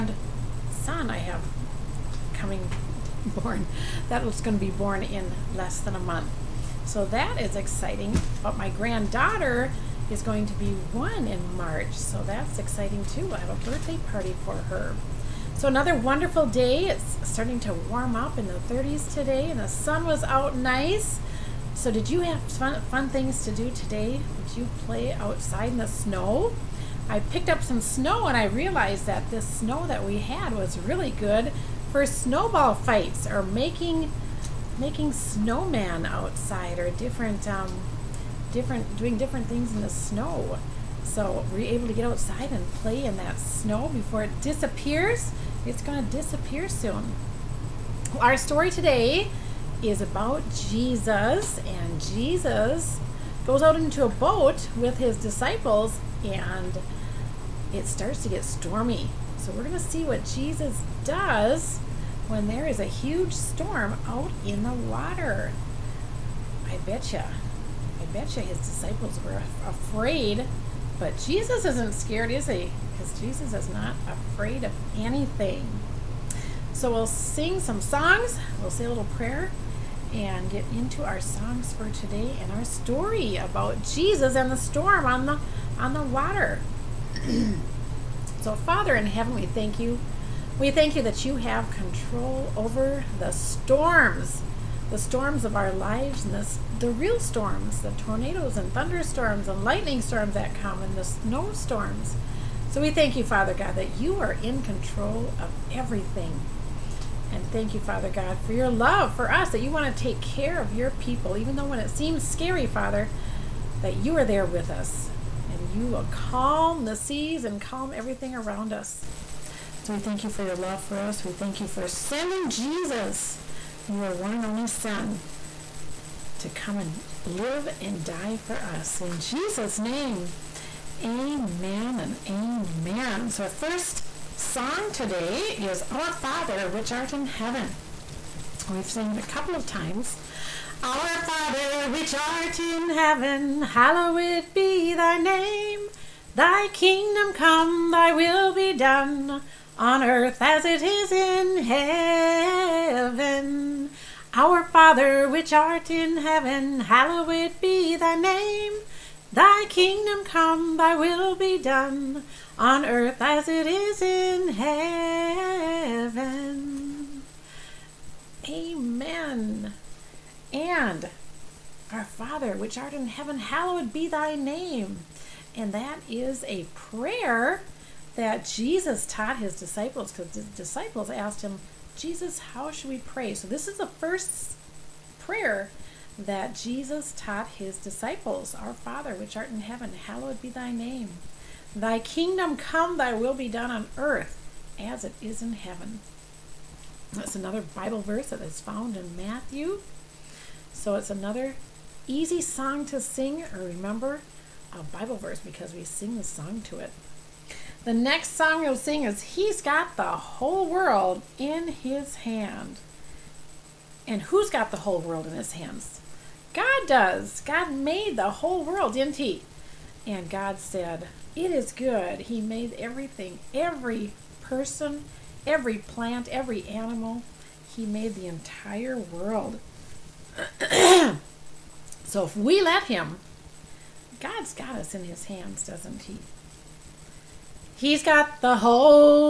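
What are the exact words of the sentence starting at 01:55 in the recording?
And you will calm the seas and calm everything around us.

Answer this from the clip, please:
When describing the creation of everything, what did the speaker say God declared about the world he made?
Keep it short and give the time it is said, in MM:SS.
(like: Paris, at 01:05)
It is good, at 03:41.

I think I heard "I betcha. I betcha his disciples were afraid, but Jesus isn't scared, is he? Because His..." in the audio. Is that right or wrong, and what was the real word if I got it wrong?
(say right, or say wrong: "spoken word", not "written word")
wrong: "Jesus", not "His".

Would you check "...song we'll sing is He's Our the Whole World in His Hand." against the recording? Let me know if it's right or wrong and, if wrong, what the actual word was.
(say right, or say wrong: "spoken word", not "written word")
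wrong: "Got", not "Our".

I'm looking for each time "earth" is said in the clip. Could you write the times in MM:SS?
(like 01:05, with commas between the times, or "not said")
02:30, 02:42, 03:13.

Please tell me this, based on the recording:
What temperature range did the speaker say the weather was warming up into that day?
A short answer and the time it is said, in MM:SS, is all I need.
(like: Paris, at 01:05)
the 30s, at 00:18.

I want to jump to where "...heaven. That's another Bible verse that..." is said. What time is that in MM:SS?
03:15.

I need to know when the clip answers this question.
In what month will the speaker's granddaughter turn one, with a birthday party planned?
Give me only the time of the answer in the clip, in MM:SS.
00:11.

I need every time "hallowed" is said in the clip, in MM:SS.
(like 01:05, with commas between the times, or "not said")
02:23, 02:36, 02:53, 03:10.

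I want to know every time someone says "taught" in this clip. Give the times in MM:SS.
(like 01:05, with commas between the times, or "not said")
02:59, 03:07.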